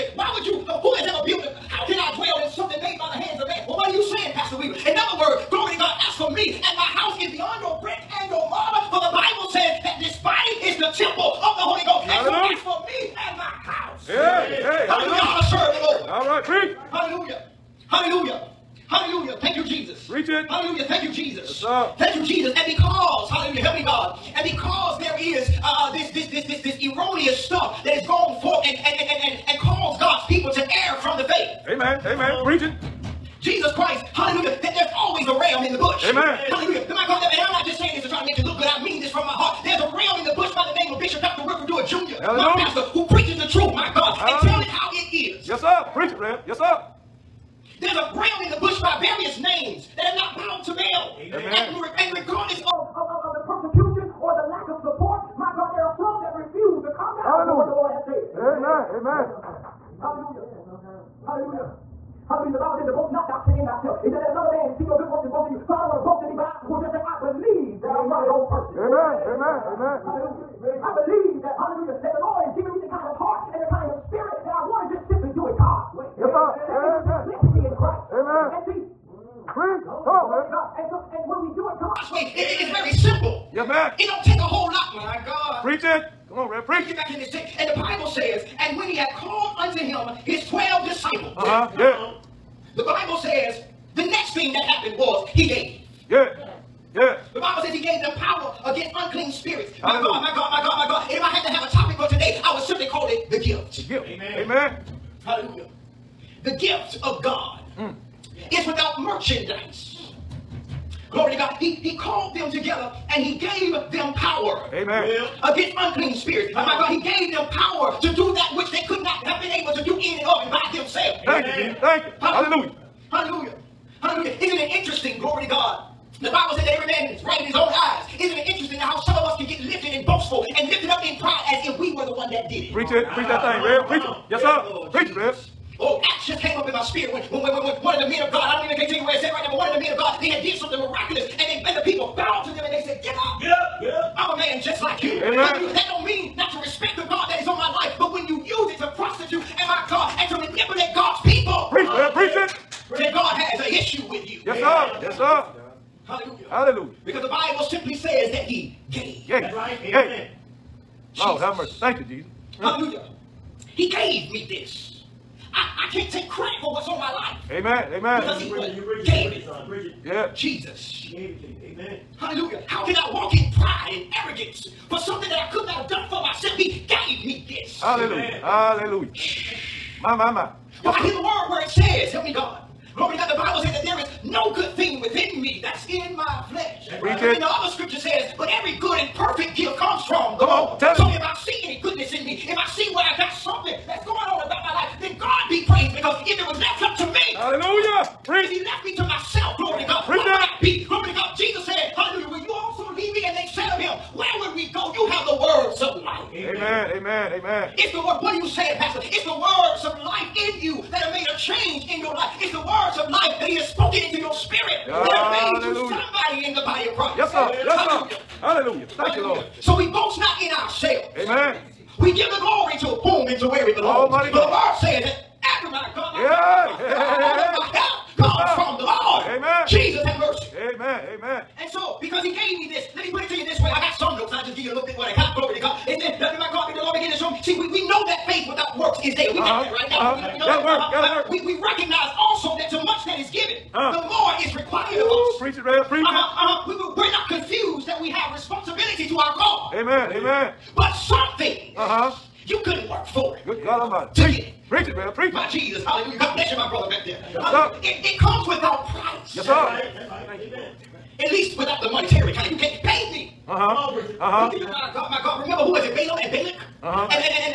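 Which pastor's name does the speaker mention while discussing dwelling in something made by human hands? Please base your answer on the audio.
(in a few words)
Pastor Weaver.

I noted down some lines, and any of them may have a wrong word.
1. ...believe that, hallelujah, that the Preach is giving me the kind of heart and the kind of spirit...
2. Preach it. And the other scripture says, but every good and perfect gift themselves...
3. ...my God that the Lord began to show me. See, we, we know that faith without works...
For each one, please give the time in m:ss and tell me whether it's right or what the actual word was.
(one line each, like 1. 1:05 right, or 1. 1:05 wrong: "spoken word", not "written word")
1. 1:11 wrong: "Lord", not "Preach"
2. 3:06 wrong: "comes", not "themselves"
3. 3:56 right.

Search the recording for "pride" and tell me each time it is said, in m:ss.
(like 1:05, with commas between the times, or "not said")
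2:11, 2:53.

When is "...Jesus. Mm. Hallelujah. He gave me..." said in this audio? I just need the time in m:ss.
2:42.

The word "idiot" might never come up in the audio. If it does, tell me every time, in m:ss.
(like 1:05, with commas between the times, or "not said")
not said.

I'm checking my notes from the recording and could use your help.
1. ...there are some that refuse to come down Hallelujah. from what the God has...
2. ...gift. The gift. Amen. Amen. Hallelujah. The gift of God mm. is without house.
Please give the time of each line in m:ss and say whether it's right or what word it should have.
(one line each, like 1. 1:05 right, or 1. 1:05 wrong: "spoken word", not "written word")
1. 0:55 wrong: "Lord", not "God"
2. 1:43 wrong: "merchandise", not "house".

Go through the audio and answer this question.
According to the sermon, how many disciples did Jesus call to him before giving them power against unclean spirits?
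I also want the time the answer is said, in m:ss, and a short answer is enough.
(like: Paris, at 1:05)
12, at 1:30.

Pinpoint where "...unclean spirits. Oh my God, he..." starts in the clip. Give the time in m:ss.
1:55.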